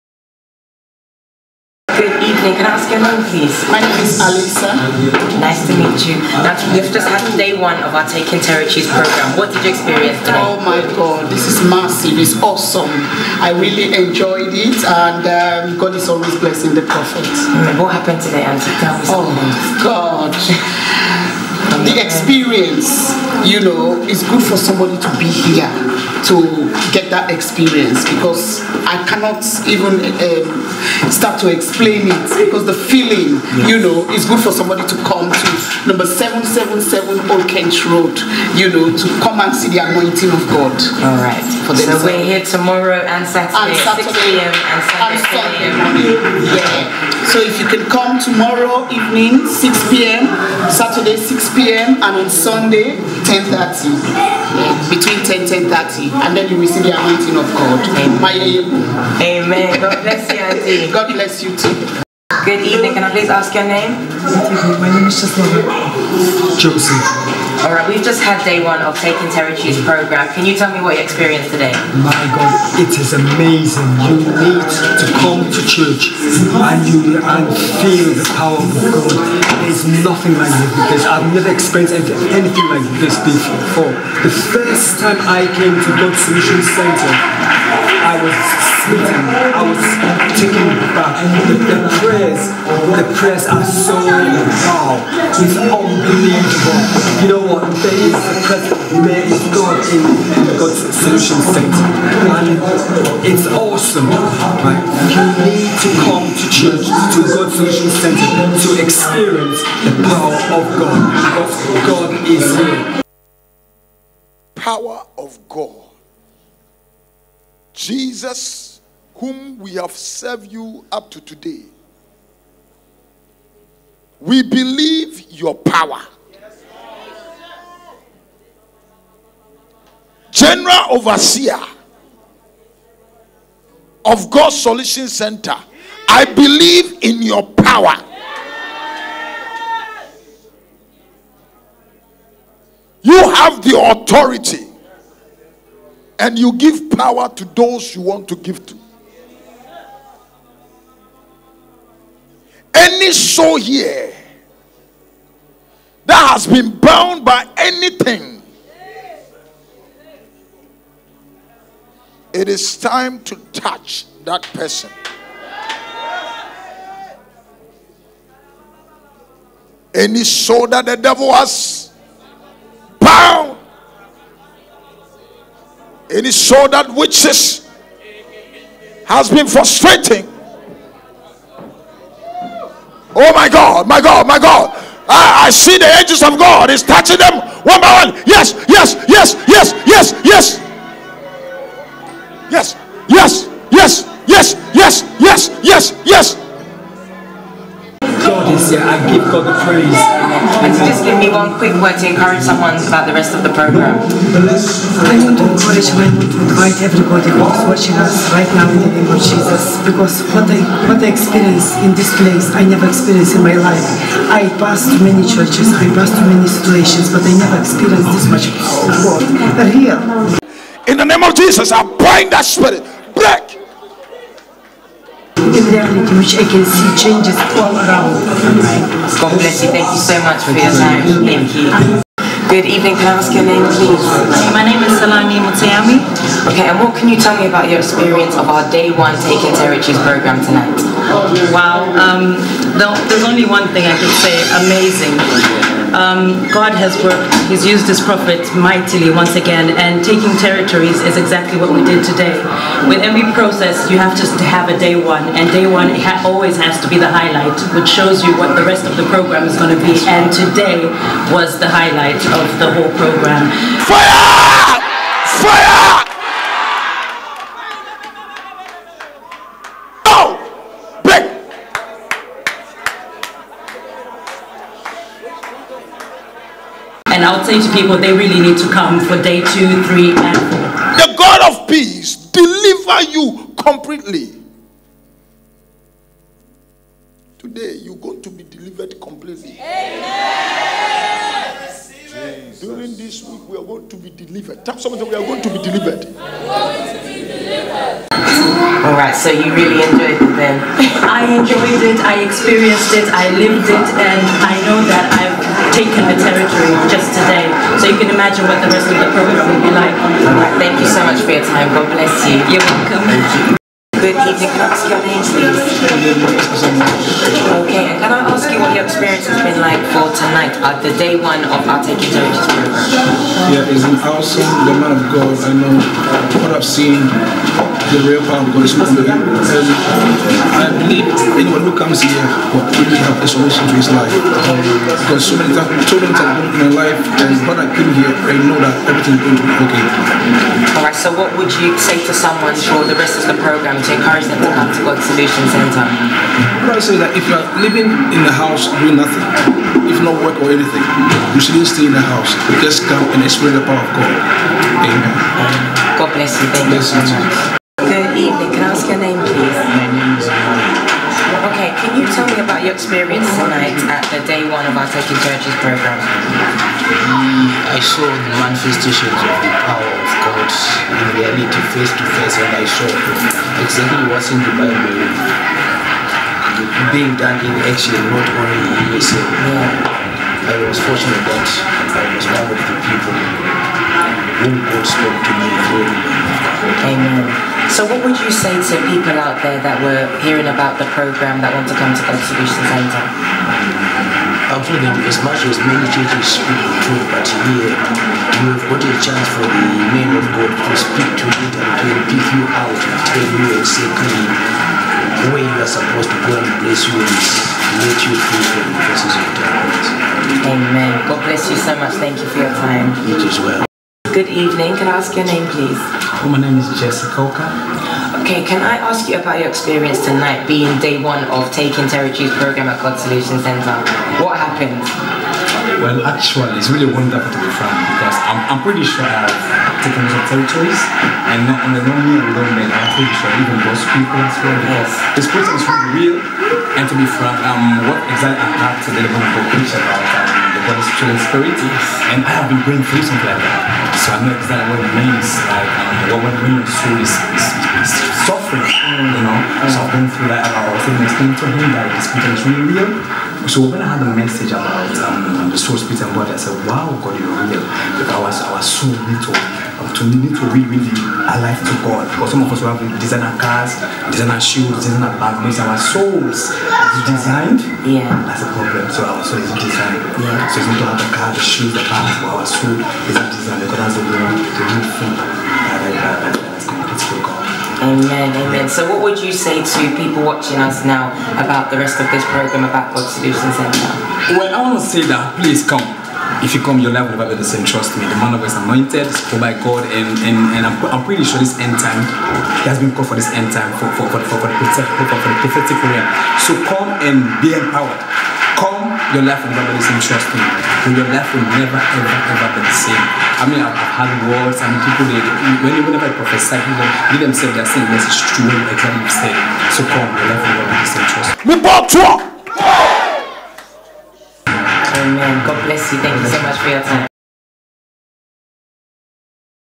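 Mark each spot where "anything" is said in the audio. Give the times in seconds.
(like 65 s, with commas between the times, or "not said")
82 s, 157 s, 350 s.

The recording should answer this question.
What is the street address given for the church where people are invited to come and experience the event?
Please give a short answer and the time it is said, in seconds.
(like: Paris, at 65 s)
777 Old Kent Road, at 35 s.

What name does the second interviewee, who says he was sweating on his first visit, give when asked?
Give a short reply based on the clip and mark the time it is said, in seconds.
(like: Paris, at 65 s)
Joseph, at 64 s.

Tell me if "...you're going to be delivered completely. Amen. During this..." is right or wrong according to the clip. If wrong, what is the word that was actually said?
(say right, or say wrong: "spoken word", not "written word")
right.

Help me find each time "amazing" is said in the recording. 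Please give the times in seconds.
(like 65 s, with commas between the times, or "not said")
73 s, 244 s.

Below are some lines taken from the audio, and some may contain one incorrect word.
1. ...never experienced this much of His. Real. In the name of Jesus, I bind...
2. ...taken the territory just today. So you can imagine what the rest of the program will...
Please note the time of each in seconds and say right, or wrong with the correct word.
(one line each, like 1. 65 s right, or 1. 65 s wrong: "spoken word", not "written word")
1. 217 s wrong: "God", not "His"
2. 305 s right.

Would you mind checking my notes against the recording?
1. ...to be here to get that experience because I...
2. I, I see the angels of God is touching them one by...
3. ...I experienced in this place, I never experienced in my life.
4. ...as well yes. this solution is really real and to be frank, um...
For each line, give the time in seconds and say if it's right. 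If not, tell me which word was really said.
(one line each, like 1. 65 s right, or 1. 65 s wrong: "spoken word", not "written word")
1. 24 s right
2. 185 s right
3. 211 s right
4. 434 s wrong: "person", not "solution".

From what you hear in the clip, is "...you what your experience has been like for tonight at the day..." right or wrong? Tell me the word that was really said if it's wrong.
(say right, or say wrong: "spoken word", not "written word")
right.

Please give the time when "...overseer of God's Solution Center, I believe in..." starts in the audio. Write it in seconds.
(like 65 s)
130 s.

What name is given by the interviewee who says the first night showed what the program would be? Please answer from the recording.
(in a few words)
Salami Mutayami.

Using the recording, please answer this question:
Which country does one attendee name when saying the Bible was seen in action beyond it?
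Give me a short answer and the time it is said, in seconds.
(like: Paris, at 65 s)
USA, at 378 s.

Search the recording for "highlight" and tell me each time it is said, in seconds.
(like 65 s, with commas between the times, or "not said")
257 s, 261 s.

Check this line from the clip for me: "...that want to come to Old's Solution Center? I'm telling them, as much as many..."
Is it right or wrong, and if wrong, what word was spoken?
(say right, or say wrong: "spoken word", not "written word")
wrong: "God", not "Old".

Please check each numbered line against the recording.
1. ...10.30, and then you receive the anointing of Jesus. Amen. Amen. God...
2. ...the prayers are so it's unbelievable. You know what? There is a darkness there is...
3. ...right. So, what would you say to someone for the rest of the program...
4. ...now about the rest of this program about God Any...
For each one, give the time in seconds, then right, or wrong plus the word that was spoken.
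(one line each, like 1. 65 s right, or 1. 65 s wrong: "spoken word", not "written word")
1. 55 s wrong: "God", not "Jesus"
2. 92 s wrong: "press", not "darkness"
3. 340 s right
4. 480 s wrong: "Solution", not "Any".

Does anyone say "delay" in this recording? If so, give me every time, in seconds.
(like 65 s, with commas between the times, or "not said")
not said.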